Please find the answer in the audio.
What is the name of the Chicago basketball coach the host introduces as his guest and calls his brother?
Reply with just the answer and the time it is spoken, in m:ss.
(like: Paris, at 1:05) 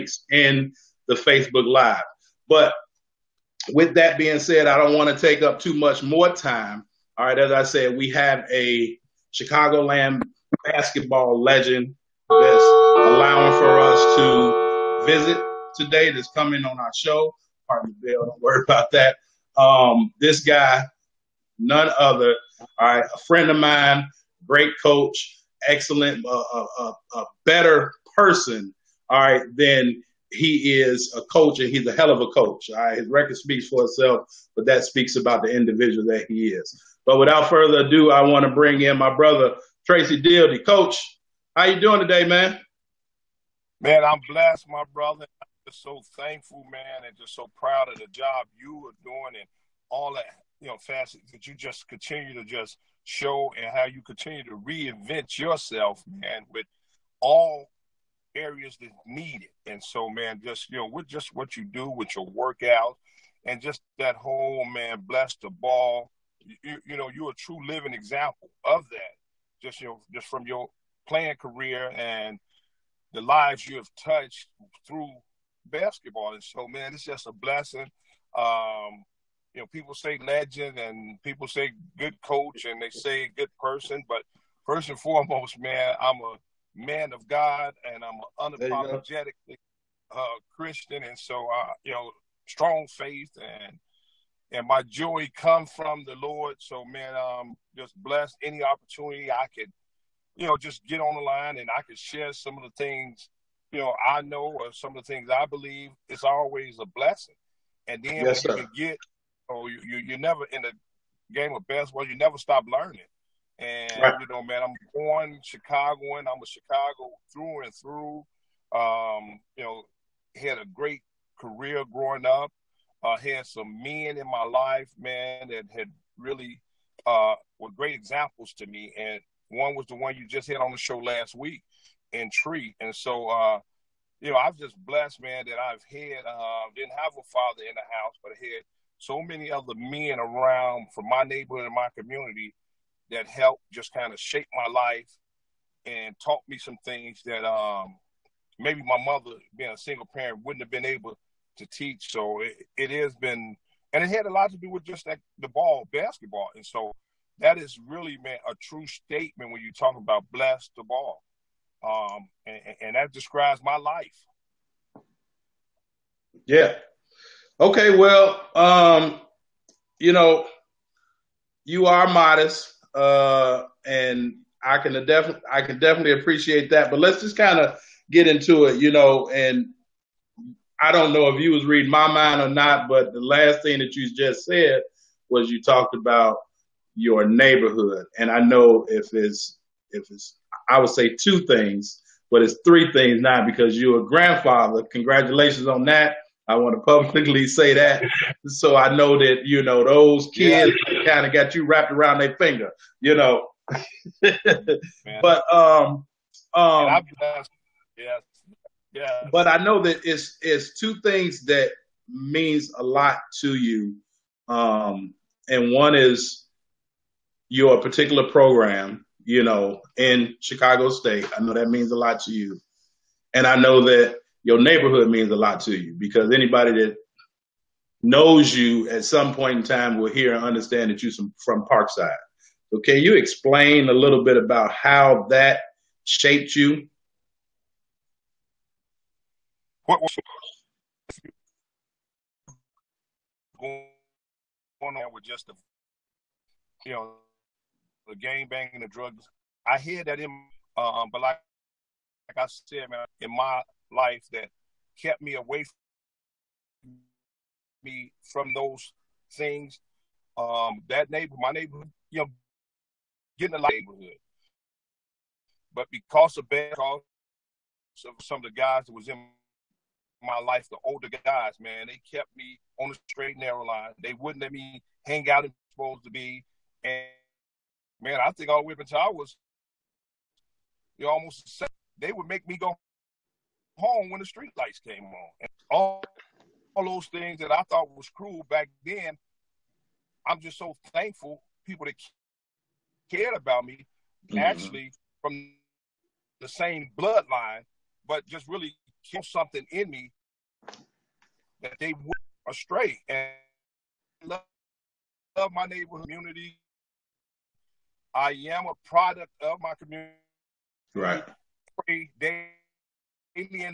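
Tracy Dildy, at 0:39.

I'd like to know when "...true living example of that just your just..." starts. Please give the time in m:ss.
1:07.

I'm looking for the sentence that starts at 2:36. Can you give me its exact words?
And so that is really, meant a true statement when you talk about bless the ball.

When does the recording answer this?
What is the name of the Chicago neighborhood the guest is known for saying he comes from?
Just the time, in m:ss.
3:51.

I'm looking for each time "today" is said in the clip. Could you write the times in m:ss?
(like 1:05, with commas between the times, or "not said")
0:15, 0:41.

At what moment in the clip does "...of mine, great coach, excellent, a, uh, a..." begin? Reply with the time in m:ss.
0:23.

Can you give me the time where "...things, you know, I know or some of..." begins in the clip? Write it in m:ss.
1:42.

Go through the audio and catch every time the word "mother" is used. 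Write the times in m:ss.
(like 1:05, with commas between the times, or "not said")
2:29.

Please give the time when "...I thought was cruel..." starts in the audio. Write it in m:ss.
4:47.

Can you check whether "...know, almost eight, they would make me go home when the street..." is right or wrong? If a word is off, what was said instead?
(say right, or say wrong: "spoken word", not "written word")
wrong: "seven", not "eight".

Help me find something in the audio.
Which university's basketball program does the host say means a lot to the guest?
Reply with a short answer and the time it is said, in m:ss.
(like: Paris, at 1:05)
Chicago State, at 3:40.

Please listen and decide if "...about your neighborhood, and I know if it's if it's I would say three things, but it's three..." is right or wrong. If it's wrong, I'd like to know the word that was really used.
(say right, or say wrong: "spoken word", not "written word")
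wrong: "two", not "three".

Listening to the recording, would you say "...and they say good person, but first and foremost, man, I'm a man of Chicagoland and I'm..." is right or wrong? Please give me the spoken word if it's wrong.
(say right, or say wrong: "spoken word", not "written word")
wrong: "God", not "Chicagoland".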